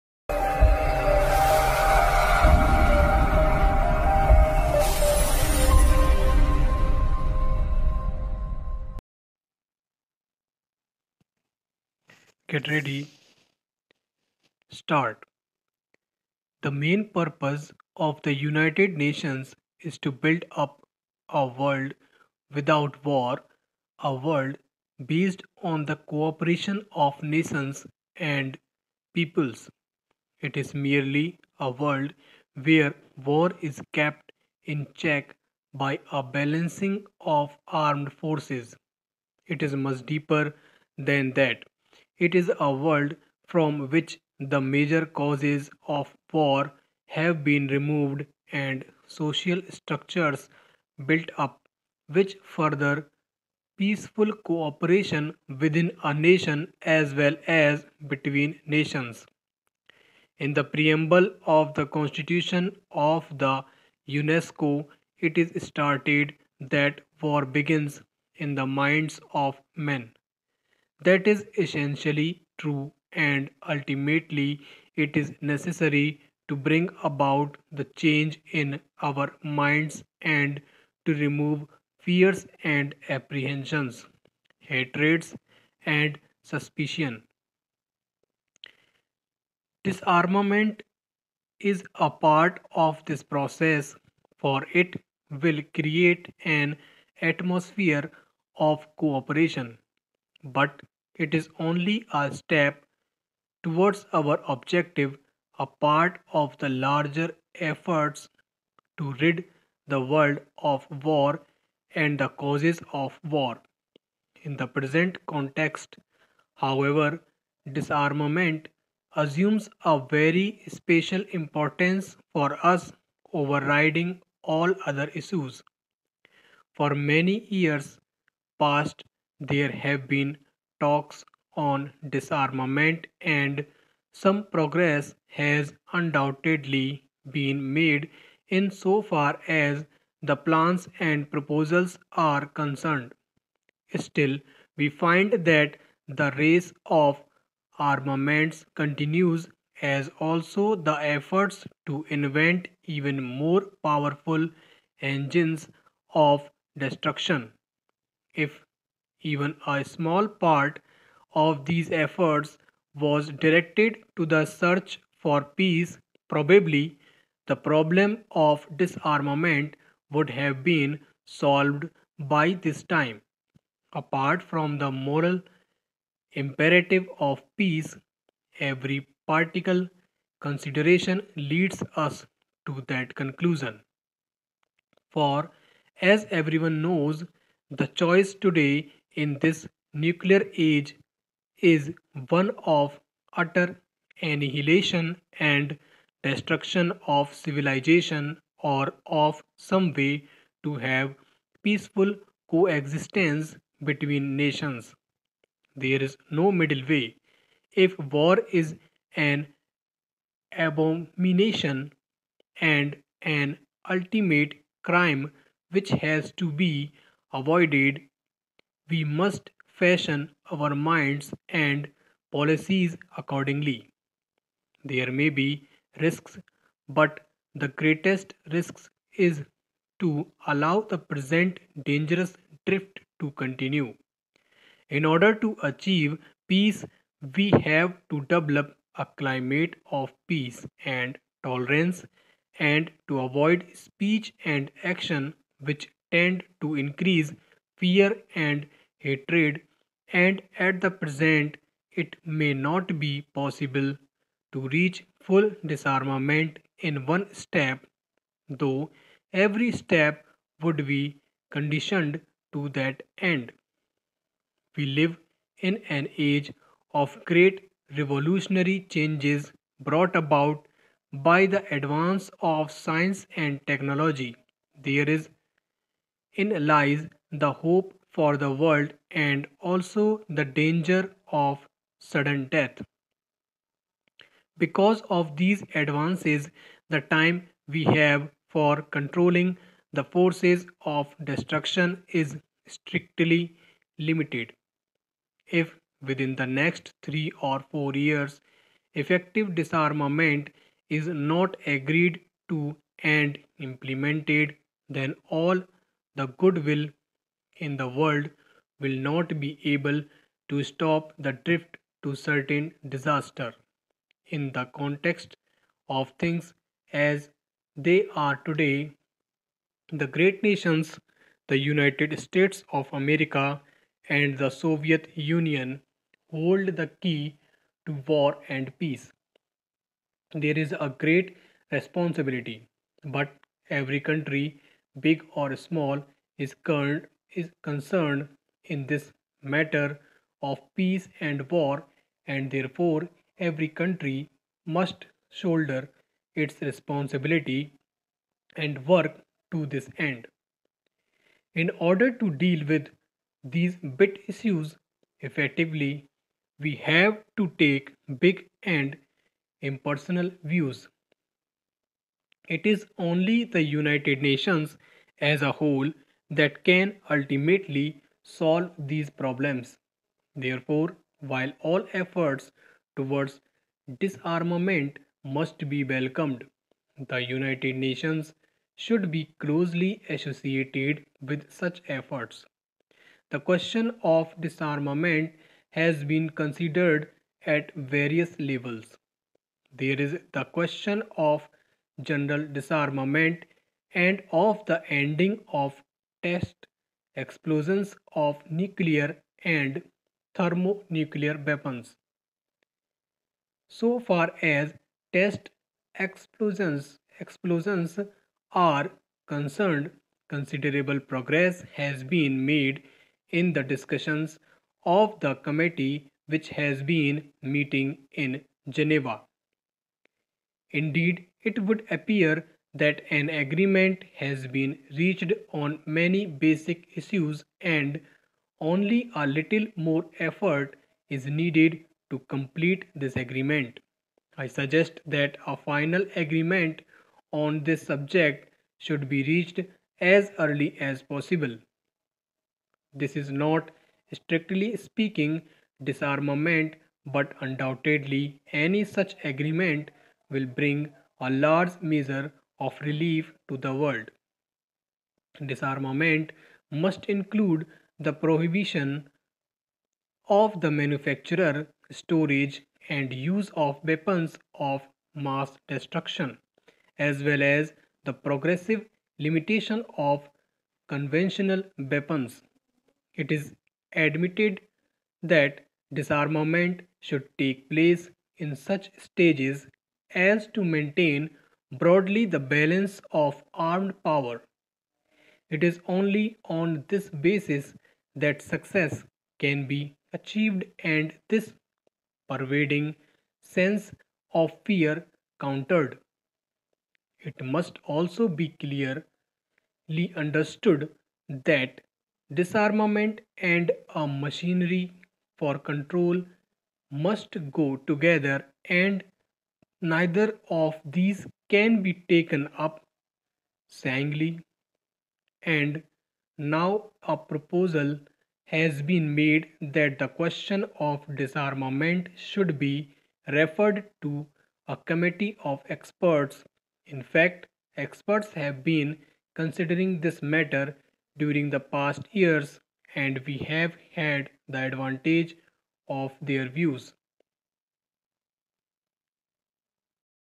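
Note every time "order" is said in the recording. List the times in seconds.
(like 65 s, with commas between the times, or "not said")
235 s, 351 s.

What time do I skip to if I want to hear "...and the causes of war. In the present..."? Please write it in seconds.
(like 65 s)
111 s.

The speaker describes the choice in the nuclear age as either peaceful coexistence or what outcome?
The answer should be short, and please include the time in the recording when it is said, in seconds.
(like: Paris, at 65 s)
utter annihilation, at 193 s.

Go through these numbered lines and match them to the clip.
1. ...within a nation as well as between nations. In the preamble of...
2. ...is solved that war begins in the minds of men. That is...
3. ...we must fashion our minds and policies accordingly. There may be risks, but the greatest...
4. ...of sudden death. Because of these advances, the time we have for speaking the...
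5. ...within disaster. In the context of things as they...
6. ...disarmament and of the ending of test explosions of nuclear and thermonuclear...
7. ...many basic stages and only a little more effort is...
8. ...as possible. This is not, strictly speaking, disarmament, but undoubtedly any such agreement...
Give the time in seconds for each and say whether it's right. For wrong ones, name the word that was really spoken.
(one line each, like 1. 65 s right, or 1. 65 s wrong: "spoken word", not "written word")
1. 55 s right
2. 65 s wrong: "stated", not "solved"
3. 218 s right
4. 281 s wrong: "controlling", not "speaking"
5. 312 s wrong: "certain", not "within"
6. 392 s right
7. 425 s wrong: "issues", not "stages"
8. 440 s right.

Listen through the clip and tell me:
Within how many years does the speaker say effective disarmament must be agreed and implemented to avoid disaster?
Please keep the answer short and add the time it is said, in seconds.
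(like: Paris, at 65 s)
3 or 4 years, at 297 s.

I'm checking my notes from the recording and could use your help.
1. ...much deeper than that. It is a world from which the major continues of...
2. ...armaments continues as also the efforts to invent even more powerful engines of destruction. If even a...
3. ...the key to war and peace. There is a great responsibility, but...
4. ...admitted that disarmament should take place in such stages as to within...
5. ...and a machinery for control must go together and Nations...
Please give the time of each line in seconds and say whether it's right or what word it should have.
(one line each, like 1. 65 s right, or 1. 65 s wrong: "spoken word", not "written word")
1. 39 s wrong: "causes", not "continues"
2. 147 s right
3. 326 s right
4. 473 s wrong: "maintain", not "within"
5. 503 s wrong: "Neither", not "Nations".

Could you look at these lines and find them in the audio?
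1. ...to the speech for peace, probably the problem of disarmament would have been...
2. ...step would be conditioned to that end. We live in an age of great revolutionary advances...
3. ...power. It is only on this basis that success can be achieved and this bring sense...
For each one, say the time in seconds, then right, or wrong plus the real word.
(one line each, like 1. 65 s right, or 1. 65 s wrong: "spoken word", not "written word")
1. 164 s wrong: "search", not "speech"
2. 259 s wrong: "changes", not "advances"
3. 484 s wrong: "pervading", not "bring".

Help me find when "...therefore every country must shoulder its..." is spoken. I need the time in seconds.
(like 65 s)
342 s.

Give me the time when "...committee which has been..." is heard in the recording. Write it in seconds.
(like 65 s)
415 s.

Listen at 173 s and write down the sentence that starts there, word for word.
Apart from the moral imperative of peace, every particle consideration leads us to that conclusion.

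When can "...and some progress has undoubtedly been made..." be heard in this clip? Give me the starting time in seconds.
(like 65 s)
133 s.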